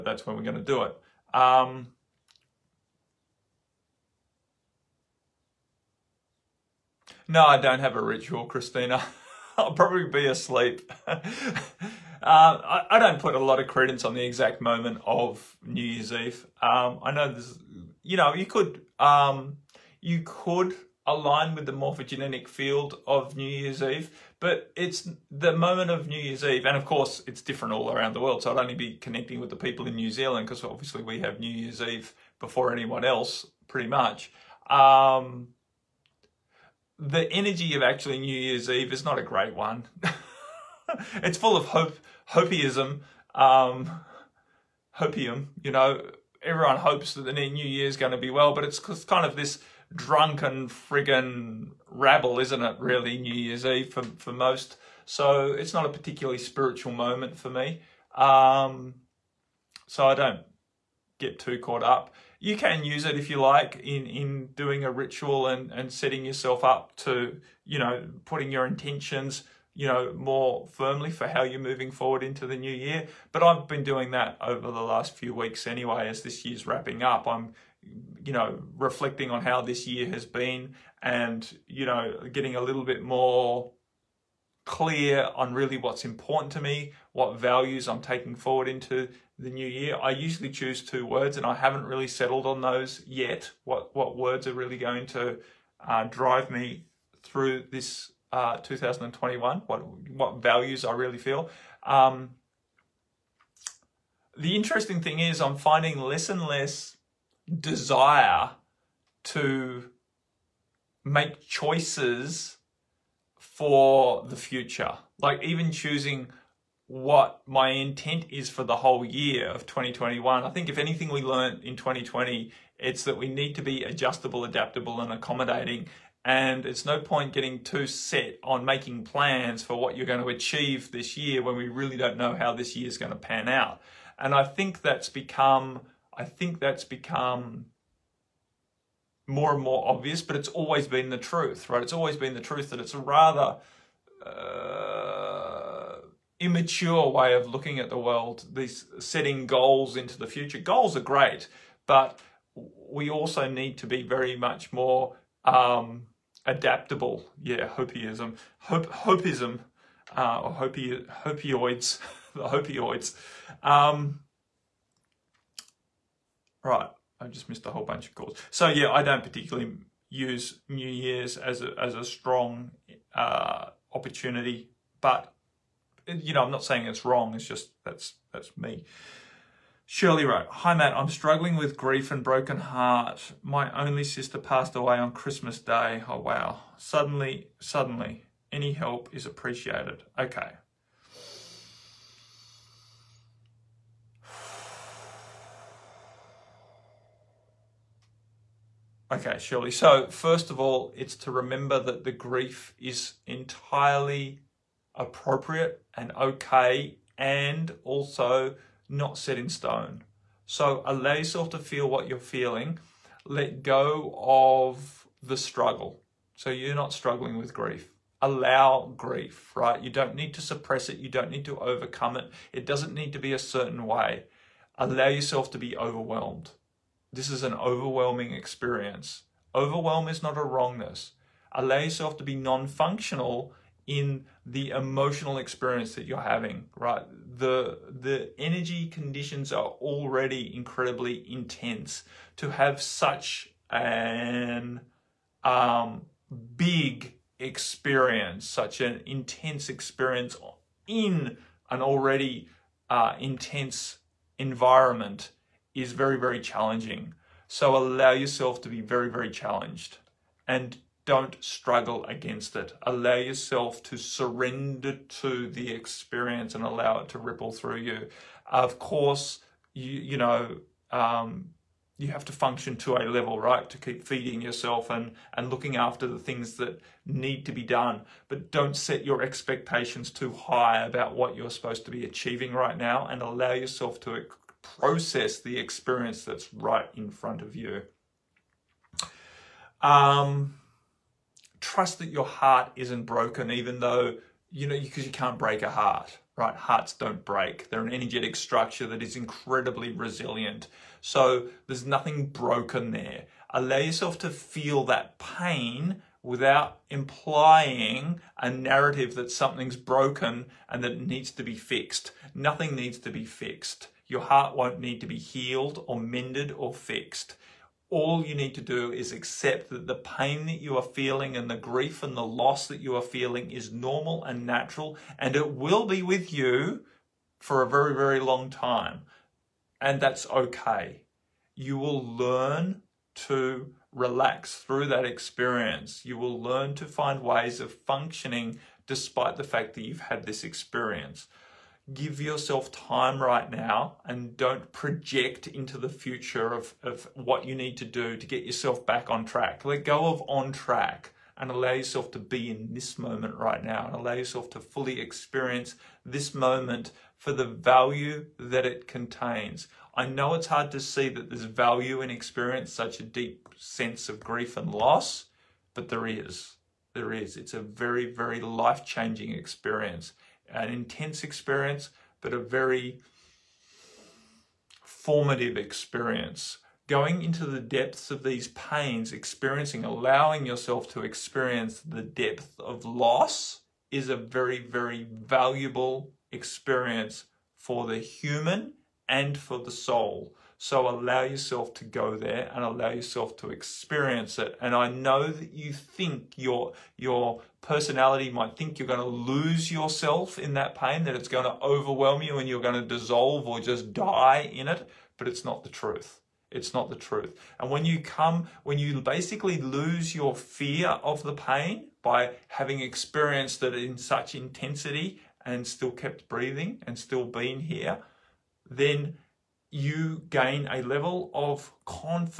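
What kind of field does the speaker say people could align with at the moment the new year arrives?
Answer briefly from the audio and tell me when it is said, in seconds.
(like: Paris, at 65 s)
morphogenetic field, at 21 s.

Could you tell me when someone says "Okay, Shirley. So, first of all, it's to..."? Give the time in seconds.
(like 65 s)
199 s.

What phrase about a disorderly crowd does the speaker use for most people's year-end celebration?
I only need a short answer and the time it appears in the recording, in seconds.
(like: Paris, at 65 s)
drunken friggin' rabble, at 49 s.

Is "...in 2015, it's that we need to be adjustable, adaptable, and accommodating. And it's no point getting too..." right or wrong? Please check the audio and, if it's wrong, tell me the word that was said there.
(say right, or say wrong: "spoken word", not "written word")
wrong: "2020", not "2015".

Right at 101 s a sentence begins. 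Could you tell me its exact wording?
Um, the interesting thing is I'm finding less and less desire to make choices for the future.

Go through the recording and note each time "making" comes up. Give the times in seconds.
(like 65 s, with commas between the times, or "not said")
128 s.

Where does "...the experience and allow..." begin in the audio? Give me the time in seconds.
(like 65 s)
265 s.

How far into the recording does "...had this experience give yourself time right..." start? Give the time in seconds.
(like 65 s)
340 s.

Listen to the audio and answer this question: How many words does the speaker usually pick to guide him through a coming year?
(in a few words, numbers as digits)
2.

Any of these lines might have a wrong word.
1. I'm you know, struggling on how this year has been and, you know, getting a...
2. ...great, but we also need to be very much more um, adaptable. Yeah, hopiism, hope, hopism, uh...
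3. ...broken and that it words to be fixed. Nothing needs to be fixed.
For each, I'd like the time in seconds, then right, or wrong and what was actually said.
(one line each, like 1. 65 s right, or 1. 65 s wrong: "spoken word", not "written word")
1. 77 s wrong: "reflecting", not "struggling"
2. 151 s right
3. 309 s wrong: "needs", not "words".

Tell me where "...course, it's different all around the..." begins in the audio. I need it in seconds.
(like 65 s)
26 s.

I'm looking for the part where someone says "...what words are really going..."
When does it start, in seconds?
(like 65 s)
93 s.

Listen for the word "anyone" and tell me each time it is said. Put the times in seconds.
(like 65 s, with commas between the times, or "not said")
32 s.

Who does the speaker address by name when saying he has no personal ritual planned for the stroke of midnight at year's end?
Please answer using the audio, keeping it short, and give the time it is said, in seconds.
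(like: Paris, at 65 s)
Christina, at 8 s.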